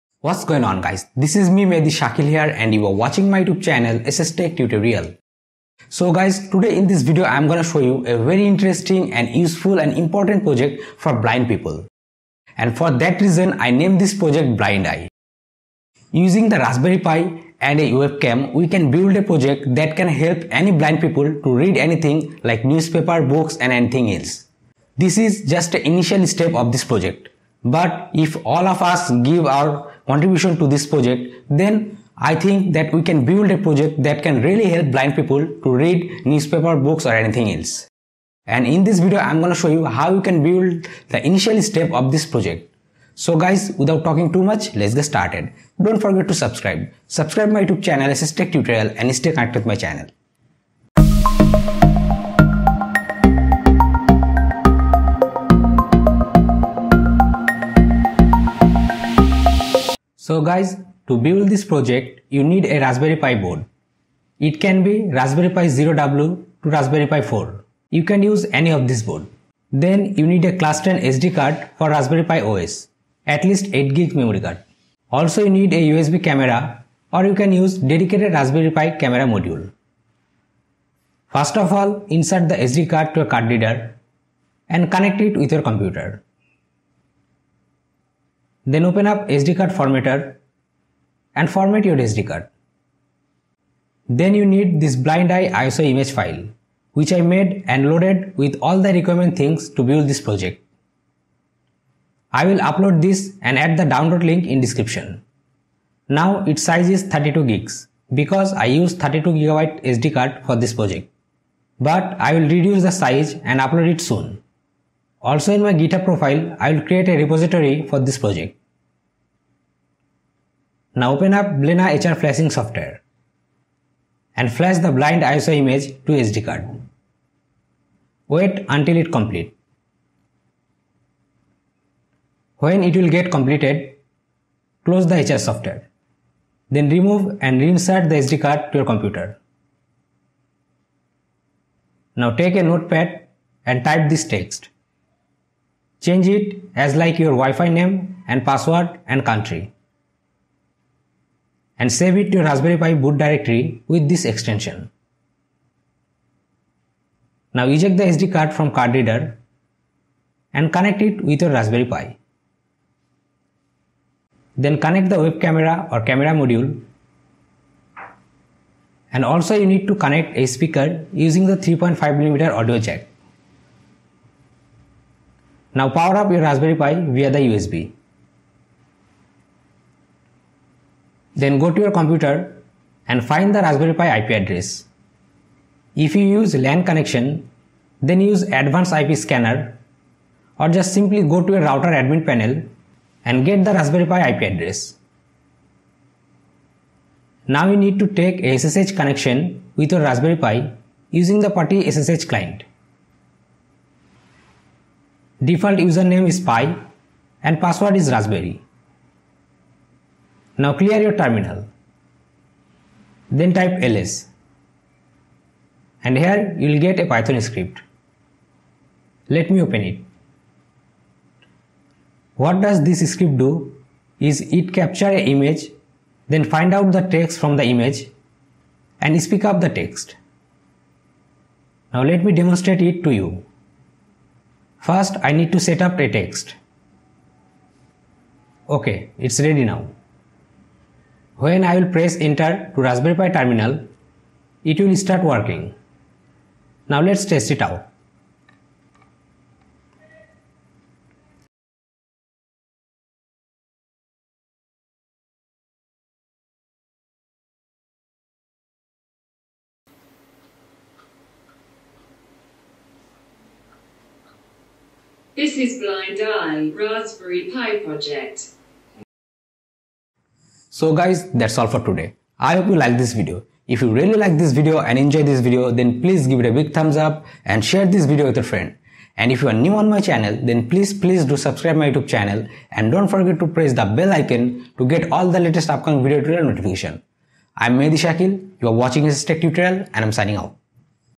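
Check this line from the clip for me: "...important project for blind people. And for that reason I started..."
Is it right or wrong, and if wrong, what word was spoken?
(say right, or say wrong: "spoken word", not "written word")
wrong: "named", not "started".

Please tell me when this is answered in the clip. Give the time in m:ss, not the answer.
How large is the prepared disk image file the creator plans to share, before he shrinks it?
1:47.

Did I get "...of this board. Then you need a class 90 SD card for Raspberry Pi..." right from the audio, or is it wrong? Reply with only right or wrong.
wrong.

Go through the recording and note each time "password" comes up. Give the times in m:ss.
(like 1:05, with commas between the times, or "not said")
2:28, 3:27.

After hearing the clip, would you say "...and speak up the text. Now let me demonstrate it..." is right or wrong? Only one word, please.
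right.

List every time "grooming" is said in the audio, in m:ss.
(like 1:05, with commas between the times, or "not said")
not said.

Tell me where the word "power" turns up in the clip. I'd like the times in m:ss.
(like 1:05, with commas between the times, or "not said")
2:55.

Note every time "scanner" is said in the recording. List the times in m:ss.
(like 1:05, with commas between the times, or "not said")
3:09.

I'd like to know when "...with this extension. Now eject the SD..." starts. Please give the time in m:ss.
2:33.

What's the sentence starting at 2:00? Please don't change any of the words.
Now open up Blina HR flashing software and flash the blind ISO image to SD card.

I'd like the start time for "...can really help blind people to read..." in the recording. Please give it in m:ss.
0:34.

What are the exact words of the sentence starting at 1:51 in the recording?
But I will reduce the size and upload it soon.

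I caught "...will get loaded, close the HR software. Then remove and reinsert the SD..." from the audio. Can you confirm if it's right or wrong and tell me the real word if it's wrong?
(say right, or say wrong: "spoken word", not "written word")
wrong: "completed", not "loaded".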